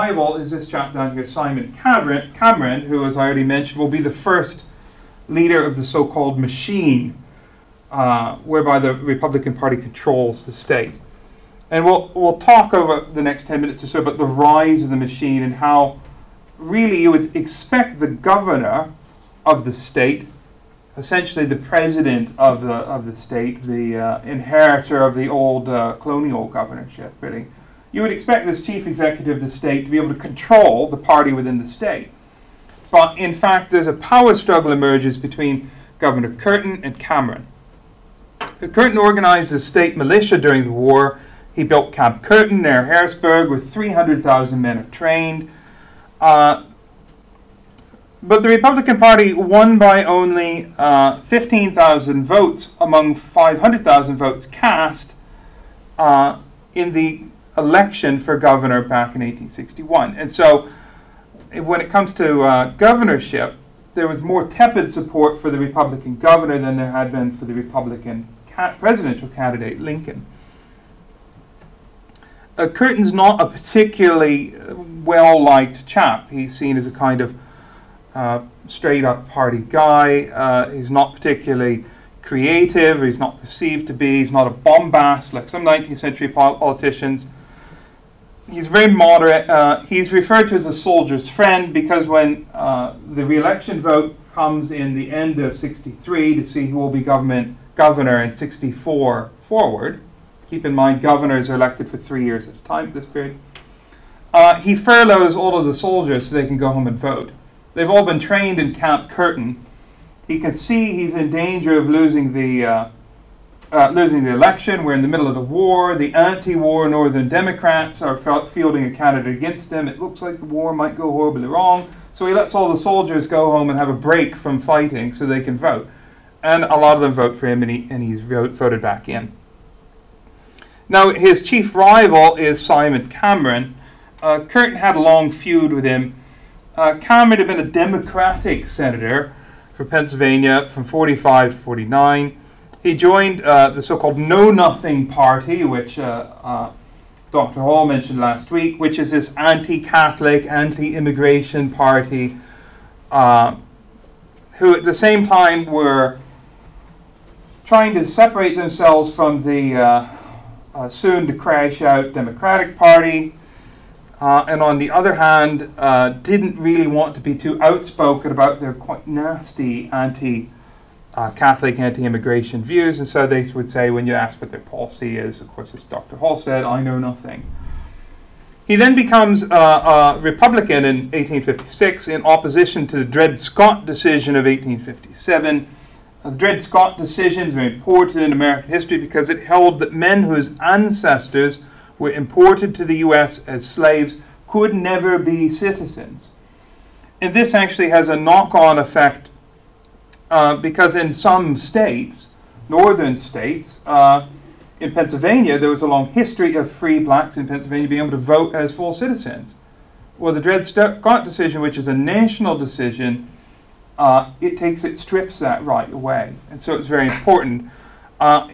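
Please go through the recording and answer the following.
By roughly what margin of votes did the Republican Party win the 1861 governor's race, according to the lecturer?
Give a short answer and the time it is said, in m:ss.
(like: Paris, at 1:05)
15,000 votes, at 0:51.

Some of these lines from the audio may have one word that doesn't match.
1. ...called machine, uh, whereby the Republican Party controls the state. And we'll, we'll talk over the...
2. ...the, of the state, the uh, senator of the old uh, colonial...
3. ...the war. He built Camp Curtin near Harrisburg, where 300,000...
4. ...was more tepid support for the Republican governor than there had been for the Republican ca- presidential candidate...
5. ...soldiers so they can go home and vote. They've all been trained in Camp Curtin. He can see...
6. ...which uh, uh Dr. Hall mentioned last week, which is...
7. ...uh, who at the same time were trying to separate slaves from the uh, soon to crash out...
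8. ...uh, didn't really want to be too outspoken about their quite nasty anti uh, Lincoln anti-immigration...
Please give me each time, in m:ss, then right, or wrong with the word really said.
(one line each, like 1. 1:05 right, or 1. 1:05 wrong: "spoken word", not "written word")
1. 0:06 right
2. 0:22 wrong: "inheritor", not "senator"
3. 0:40 right
4. 1:04 right
5. 1:45 right
6. 2:25 right
7. 2:33 wrong: "themselves", not "slaves"
8. 2:45 wrong: "Catholic", not "Lincoln".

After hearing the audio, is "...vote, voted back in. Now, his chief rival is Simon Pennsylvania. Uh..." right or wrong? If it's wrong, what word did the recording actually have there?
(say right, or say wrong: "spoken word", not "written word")
wrong: "Cameron", not "Pennsylvania".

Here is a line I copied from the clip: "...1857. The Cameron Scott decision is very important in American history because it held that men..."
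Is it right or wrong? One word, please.
wrong.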